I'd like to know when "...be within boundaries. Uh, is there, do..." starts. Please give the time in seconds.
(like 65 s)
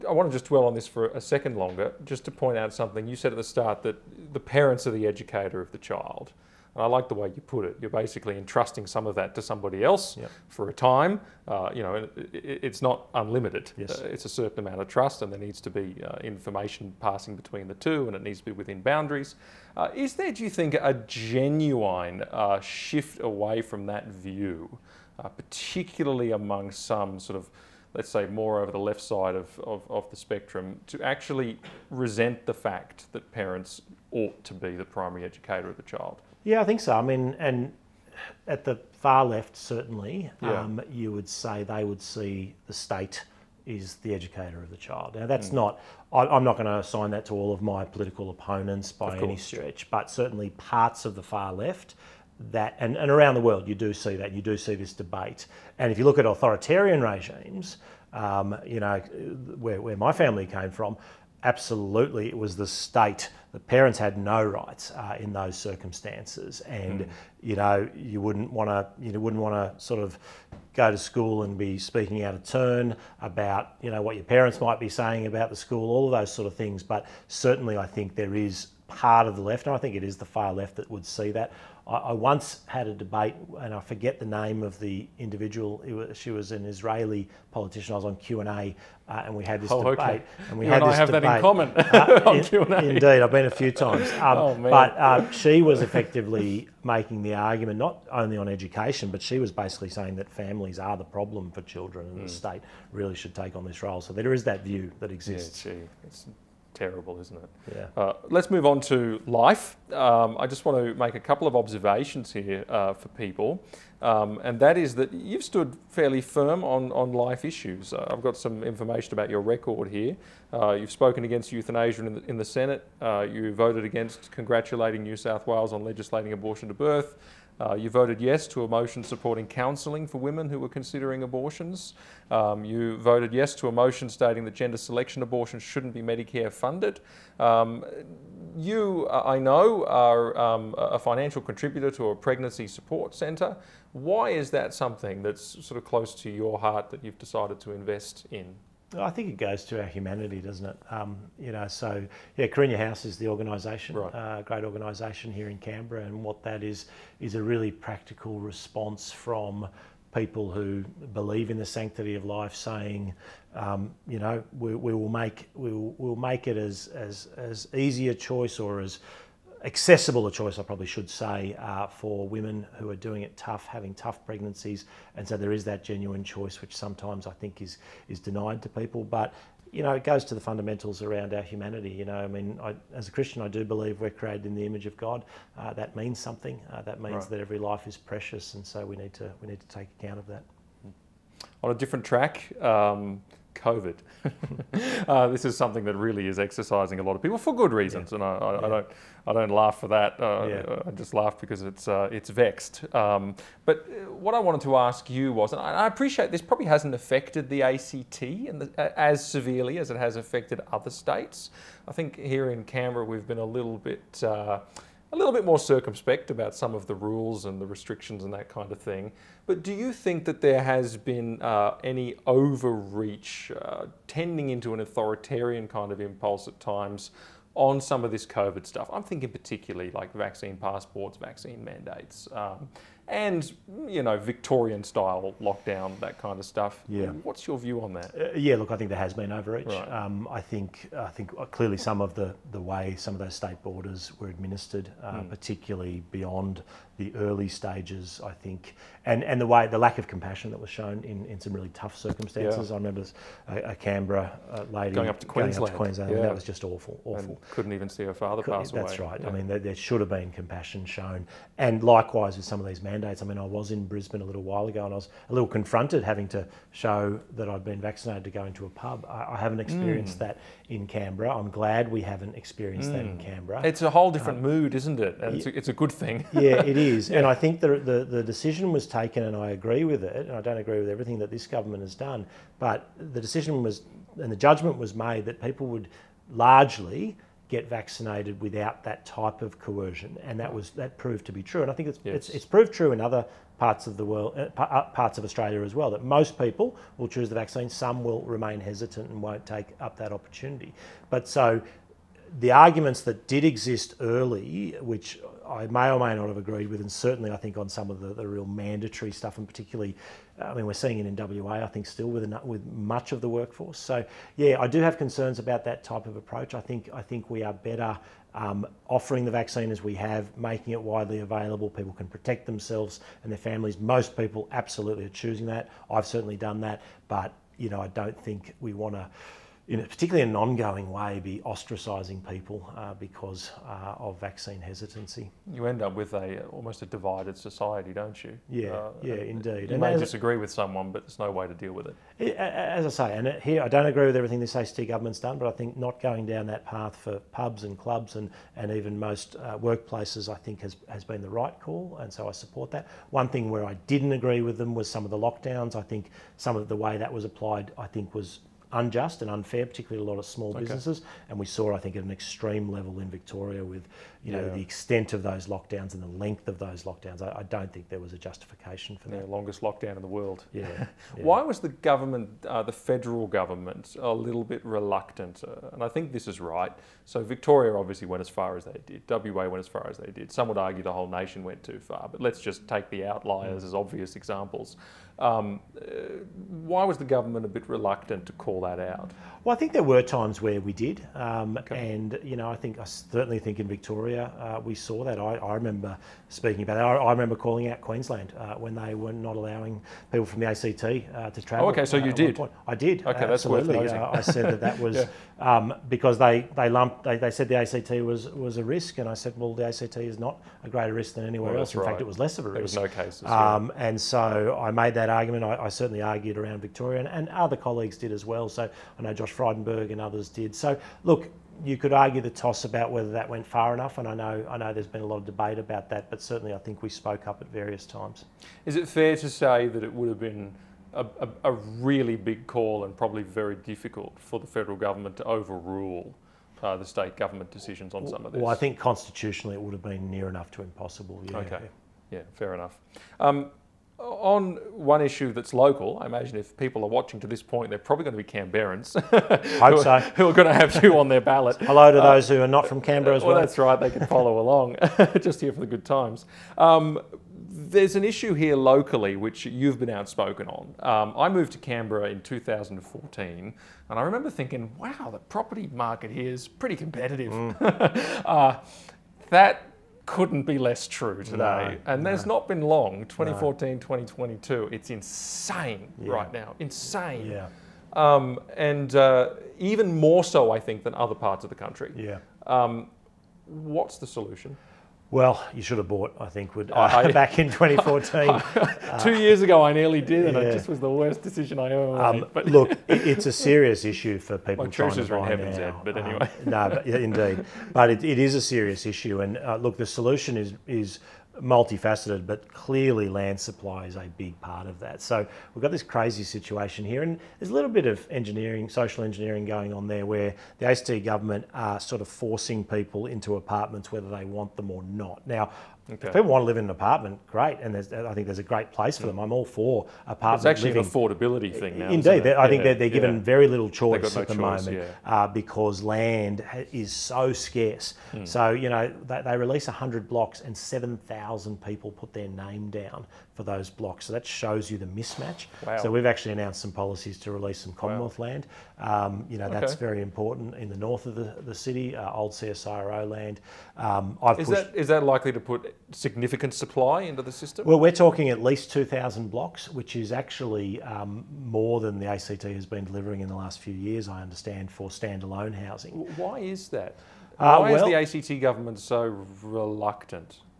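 18 s.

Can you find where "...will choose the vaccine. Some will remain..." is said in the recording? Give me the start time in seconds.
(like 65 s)
296 s.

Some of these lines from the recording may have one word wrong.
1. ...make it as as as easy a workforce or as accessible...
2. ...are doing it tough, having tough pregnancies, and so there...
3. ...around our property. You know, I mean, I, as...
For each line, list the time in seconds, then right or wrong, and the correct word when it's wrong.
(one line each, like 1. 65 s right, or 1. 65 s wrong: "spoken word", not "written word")
1. 166 s wrong: "choice", not "workforce"
2. 172 s right
3. 181 s wrong: "humanity", not "property".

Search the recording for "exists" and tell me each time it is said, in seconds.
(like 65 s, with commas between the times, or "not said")
105 s, 303 s.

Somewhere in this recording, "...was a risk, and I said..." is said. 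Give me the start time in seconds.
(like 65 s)
408 s.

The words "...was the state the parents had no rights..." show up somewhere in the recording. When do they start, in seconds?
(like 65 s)
62 s.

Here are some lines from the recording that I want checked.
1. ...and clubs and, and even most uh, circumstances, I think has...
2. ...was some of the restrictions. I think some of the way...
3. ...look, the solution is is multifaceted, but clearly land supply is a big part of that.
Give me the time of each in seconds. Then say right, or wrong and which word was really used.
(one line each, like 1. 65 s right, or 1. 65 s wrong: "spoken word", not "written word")
1. 347 s wrong: "workplaces", not "circumstances"
2. 354 s wrong: "lockdowns", not "restrictions"
3. 499 s right.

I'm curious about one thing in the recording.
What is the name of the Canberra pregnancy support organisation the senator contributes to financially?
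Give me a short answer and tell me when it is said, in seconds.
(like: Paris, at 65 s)
Karinya House, at 152 s.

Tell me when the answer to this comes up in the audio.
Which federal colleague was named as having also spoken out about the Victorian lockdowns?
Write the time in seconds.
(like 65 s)
419 s.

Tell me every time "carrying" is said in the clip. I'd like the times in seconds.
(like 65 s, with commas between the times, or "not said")
not said.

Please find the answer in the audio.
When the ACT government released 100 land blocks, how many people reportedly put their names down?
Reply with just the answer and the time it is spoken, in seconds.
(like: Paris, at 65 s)
7,000, at 530 s.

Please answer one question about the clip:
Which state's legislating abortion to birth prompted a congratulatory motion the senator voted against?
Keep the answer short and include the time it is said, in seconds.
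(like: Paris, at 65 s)
New South Wales, at 125 s.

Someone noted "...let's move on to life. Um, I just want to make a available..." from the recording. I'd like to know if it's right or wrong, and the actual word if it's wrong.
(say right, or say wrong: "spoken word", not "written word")
wrong: "couple", not "available".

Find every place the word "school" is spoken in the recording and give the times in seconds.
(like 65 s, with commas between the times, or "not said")
70 s, 75 s.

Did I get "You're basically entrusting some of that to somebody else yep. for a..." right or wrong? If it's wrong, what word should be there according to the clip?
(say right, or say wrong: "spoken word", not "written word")
right.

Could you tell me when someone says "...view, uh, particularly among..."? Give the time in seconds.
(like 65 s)
24 s.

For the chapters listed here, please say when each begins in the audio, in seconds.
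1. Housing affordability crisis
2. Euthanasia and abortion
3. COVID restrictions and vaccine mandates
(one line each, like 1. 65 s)
1. 443 s
2. 107 s
3. 190 s.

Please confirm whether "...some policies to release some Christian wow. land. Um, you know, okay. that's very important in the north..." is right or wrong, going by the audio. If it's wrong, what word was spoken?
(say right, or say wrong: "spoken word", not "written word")
wrong: "Commonwealth", not "Christian".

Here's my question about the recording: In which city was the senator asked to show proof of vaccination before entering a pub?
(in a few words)
Brisbane.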